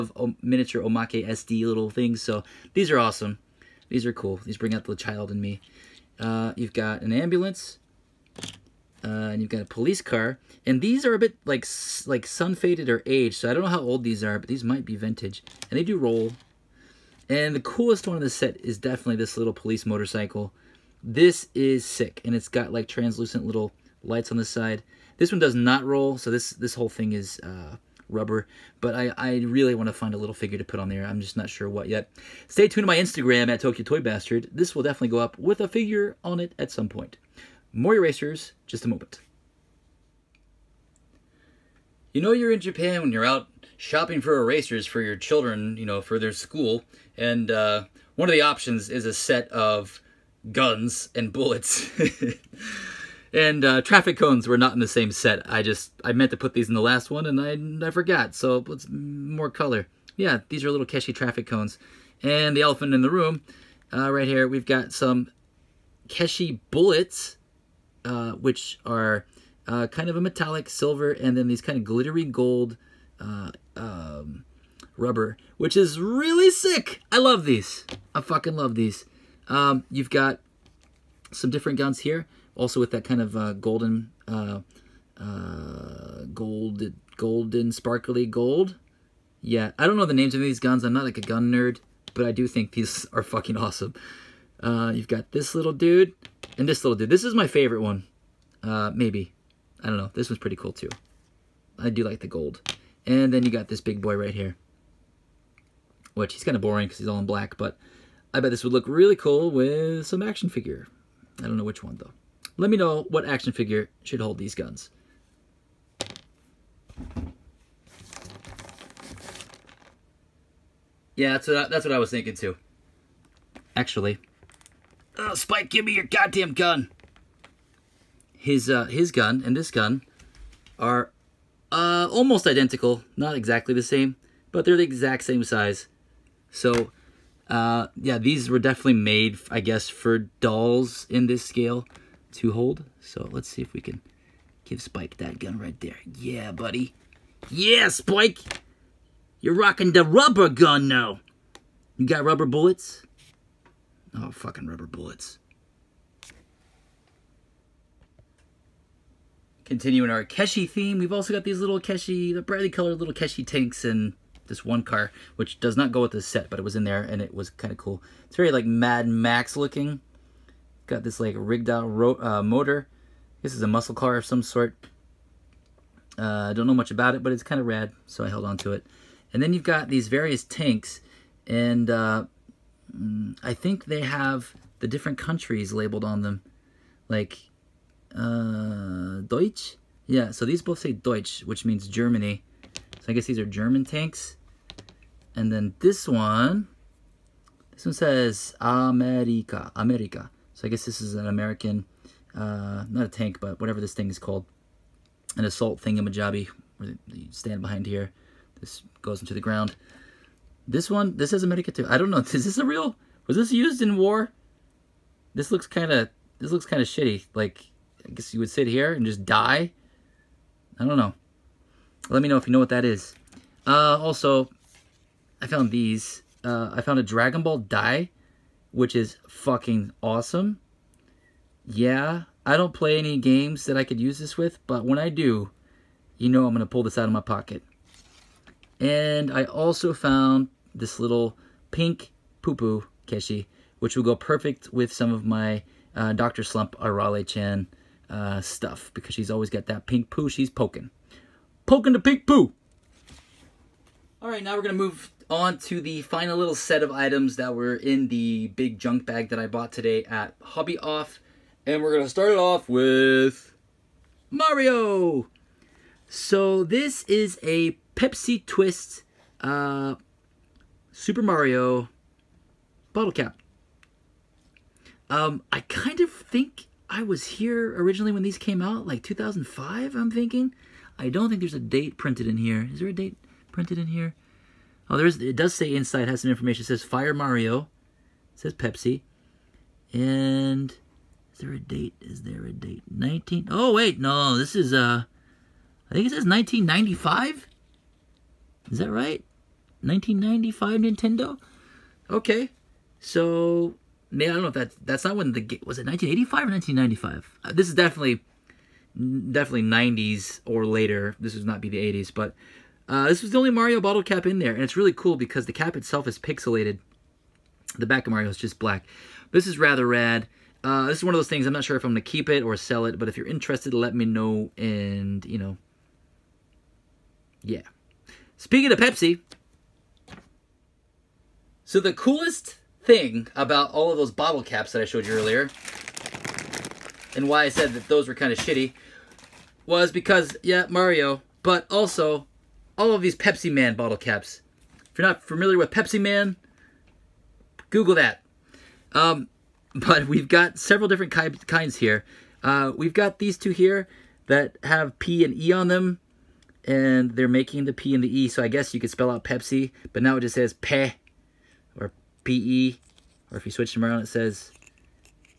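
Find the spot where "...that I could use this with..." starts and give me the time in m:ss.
3:53.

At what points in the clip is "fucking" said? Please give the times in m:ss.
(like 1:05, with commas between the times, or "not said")
1:18, 1:33, 2:34, 3:49.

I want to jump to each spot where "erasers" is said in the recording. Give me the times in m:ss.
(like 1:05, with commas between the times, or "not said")
0:37, 0:44.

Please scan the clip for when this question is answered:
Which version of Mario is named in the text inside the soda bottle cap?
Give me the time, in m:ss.
4:46.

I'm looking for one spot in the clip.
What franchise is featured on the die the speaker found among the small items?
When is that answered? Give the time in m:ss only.
3:47.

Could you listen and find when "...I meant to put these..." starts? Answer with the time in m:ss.
0:56.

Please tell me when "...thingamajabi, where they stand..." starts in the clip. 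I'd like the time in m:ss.
3:25.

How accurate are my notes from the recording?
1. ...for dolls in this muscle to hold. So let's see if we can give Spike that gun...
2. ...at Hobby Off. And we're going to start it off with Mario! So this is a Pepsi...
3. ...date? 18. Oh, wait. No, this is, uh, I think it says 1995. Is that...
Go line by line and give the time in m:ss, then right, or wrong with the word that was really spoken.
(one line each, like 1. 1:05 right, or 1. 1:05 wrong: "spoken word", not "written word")
1. 2:19 wrong: "scale", not "muscle"
2. 4:20 right
3. 4:52 wrong: "19", not "18".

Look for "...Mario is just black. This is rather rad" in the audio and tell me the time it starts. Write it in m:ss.
5:18.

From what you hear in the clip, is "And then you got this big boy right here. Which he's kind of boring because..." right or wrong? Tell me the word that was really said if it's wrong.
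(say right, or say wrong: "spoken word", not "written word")
right.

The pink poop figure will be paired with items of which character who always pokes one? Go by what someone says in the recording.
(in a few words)
Arale-chan.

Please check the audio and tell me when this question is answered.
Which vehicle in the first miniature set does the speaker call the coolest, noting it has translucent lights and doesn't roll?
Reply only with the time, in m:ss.
0:19.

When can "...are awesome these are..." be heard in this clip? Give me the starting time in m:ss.
0:02.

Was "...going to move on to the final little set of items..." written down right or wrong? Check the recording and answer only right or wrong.
right.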